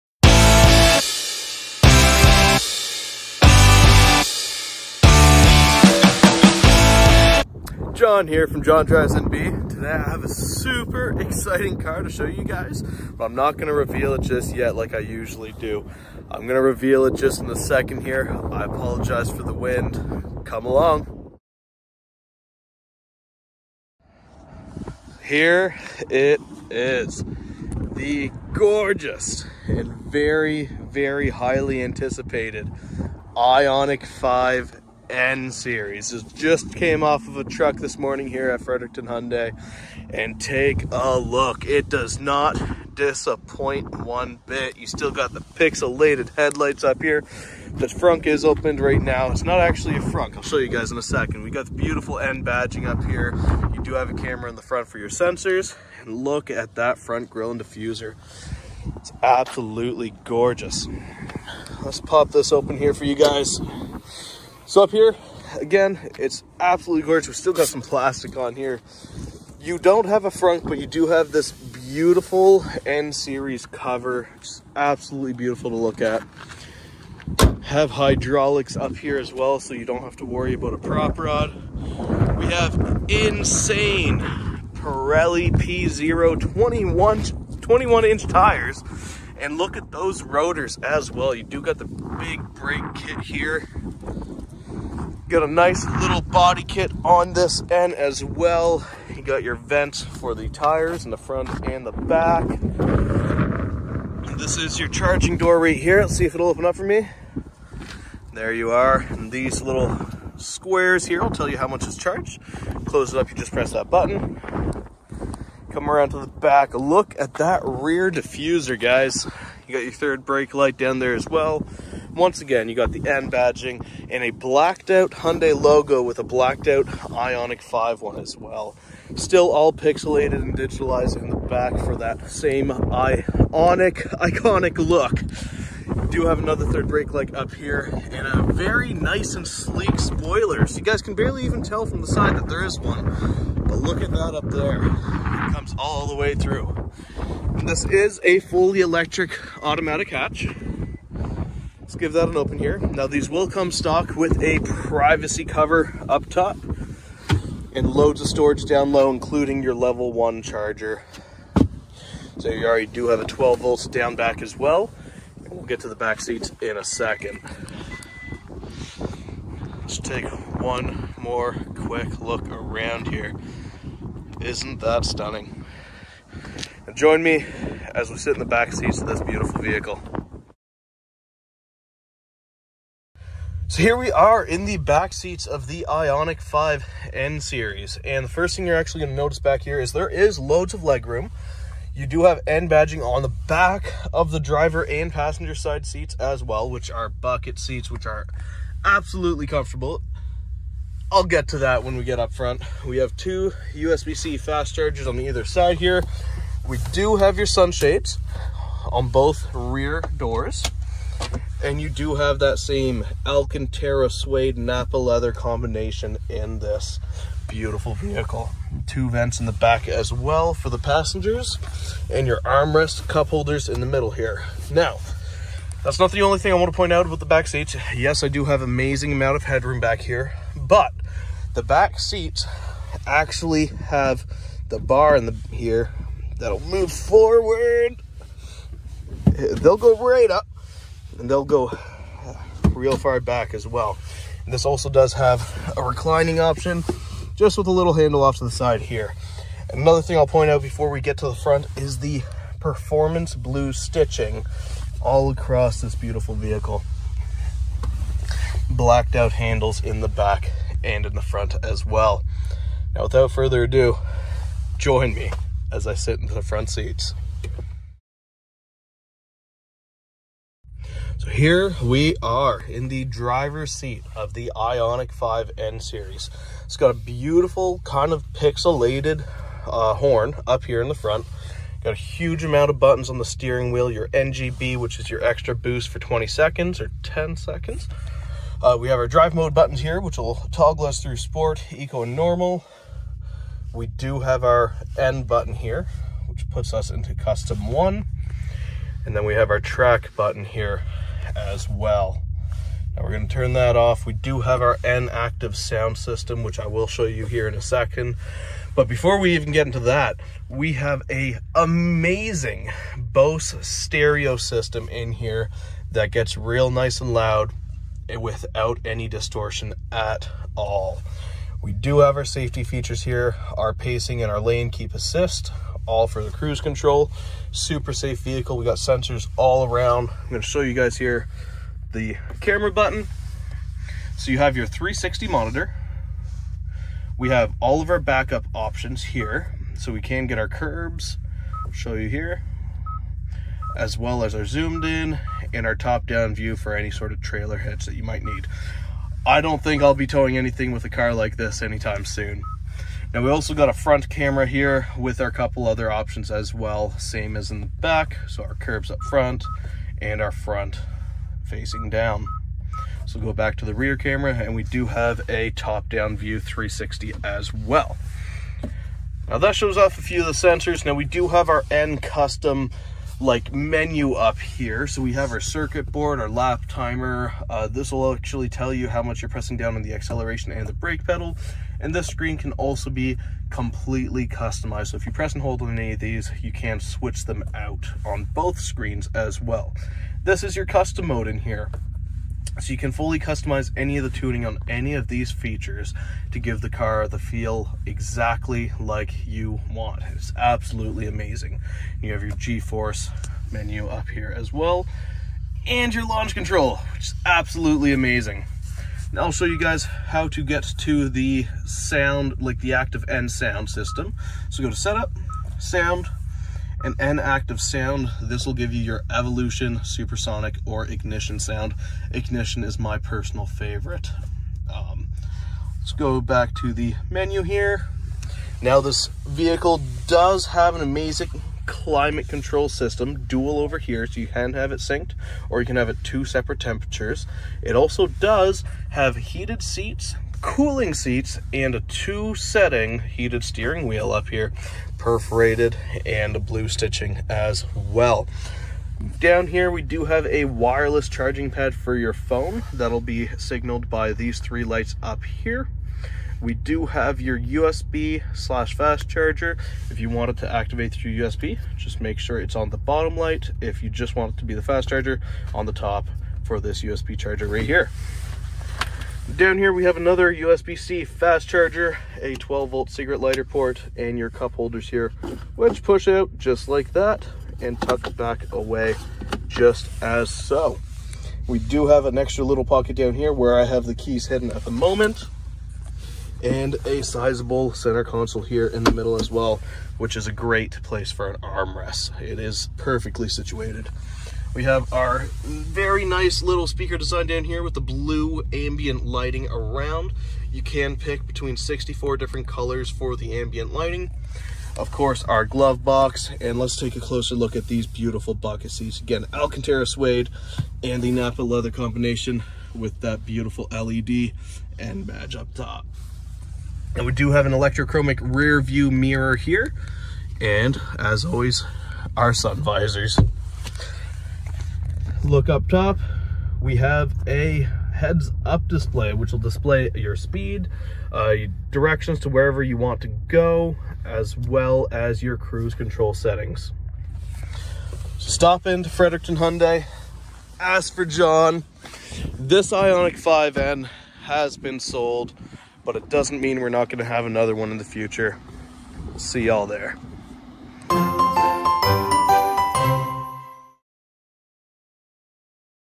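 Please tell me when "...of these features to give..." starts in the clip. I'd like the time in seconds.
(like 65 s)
394 s.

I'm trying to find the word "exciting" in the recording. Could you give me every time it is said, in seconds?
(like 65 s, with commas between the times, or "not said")
11 s.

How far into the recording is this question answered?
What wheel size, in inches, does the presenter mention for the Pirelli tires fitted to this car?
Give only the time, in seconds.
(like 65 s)
87 s.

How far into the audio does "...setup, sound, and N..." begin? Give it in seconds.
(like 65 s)
414 s.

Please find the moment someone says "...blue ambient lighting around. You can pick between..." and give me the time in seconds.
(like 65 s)
497 s.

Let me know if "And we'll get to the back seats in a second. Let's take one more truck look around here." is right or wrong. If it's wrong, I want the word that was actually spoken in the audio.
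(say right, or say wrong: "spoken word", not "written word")
wrong: "quick", not "truck".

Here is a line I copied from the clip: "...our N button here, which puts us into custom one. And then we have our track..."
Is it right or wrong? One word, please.
right.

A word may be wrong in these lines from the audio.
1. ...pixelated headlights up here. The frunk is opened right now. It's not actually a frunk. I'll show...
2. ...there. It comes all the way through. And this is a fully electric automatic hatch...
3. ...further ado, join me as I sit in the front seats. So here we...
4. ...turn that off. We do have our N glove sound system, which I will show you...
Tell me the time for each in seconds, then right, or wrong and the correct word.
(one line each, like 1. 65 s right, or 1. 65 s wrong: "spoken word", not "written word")
1. 45 s right
2. 144 s right
3. 263 s right
4. 303 s wrong: "active", not "glove".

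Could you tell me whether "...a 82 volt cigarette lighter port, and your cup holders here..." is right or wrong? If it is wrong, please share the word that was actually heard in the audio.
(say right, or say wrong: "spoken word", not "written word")
wrong: "12", not "82".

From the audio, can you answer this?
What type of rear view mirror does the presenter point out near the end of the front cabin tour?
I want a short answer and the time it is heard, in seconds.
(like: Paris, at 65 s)
electrochromic, at 517 s.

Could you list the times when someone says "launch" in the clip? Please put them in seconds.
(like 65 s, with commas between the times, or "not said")
406 s.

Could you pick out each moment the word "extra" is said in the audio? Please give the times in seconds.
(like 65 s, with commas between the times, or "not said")
285 s, 482 s.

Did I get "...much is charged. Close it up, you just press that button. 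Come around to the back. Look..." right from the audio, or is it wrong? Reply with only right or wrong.
right.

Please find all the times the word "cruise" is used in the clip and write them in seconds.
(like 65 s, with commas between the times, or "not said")
326 s, 535 s.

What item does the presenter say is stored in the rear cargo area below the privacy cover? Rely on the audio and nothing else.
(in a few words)
level one charger.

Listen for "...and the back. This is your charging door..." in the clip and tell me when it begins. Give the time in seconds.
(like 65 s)
101 s.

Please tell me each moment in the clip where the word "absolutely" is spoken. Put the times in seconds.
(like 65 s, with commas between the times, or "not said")
59 s, 66 s, 74 s, 198 s, 400 s, 407 s.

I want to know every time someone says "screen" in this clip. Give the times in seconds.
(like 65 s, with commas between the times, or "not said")
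382 s, 388 s.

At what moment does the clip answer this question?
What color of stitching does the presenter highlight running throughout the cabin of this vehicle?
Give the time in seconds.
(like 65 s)
252 s.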